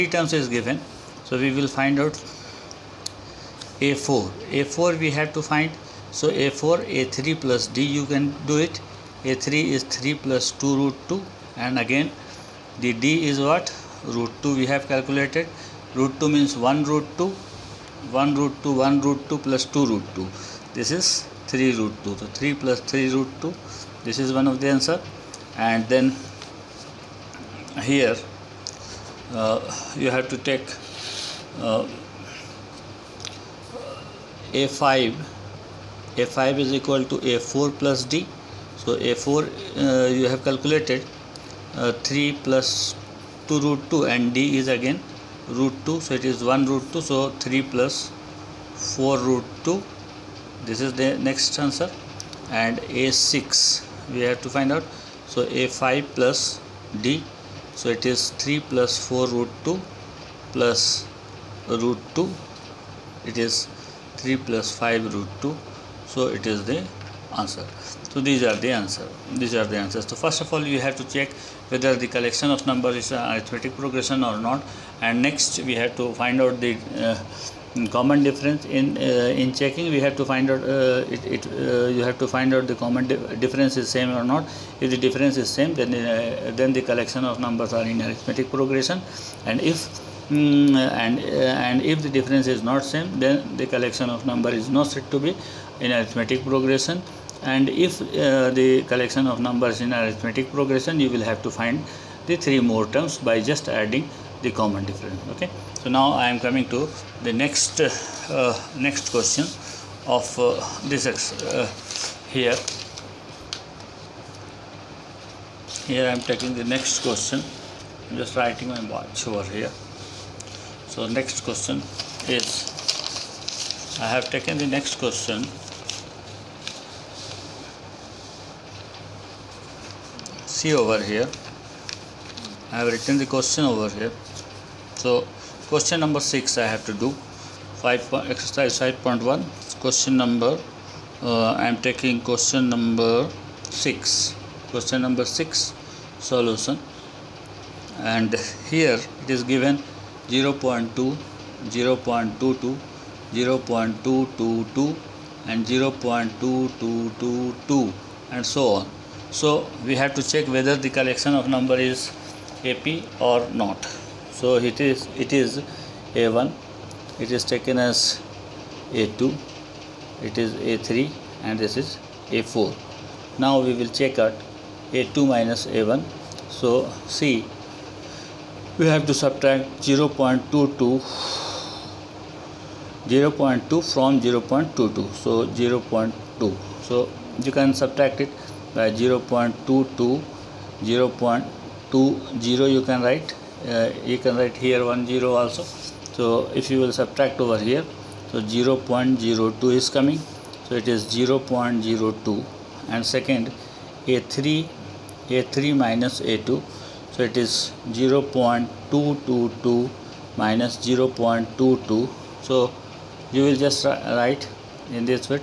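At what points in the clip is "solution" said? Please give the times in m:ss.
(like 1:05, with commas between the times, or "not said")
2:26.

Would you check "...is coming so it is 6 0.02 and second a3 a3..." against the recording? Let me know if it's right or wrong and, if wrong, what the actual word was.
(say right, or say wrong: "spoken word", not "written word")
wrong: "0", not "6".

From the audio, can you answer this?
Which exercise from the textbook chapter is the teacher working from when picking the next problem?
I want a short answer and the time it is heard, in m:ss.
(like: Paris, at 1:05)
Exercise 5.1, at 2:18.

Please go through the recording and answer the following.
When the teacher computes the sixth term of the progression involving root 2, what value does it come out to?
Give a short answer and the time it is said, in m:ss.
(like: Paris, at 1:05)
3 + 5√2, at 1:04.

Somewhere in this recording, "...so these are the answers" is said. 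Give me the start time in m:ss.
1:08.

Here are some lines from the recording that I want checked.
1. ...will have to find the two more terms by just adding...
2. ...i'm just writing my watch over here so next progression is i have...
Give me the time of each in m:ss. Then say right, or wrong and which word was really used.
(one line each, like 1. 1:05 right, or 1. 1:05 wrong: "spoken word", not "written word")
1. 1:41 wrong: "three", not "two"
2. 1:58 wrong: "question", not "progression".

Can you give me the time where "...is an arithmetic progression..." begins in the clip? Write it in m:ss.
1:12.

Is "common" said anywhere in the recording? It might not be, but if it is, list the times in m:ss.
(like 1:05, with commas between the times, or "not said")
1:17, 1:22, 1:44.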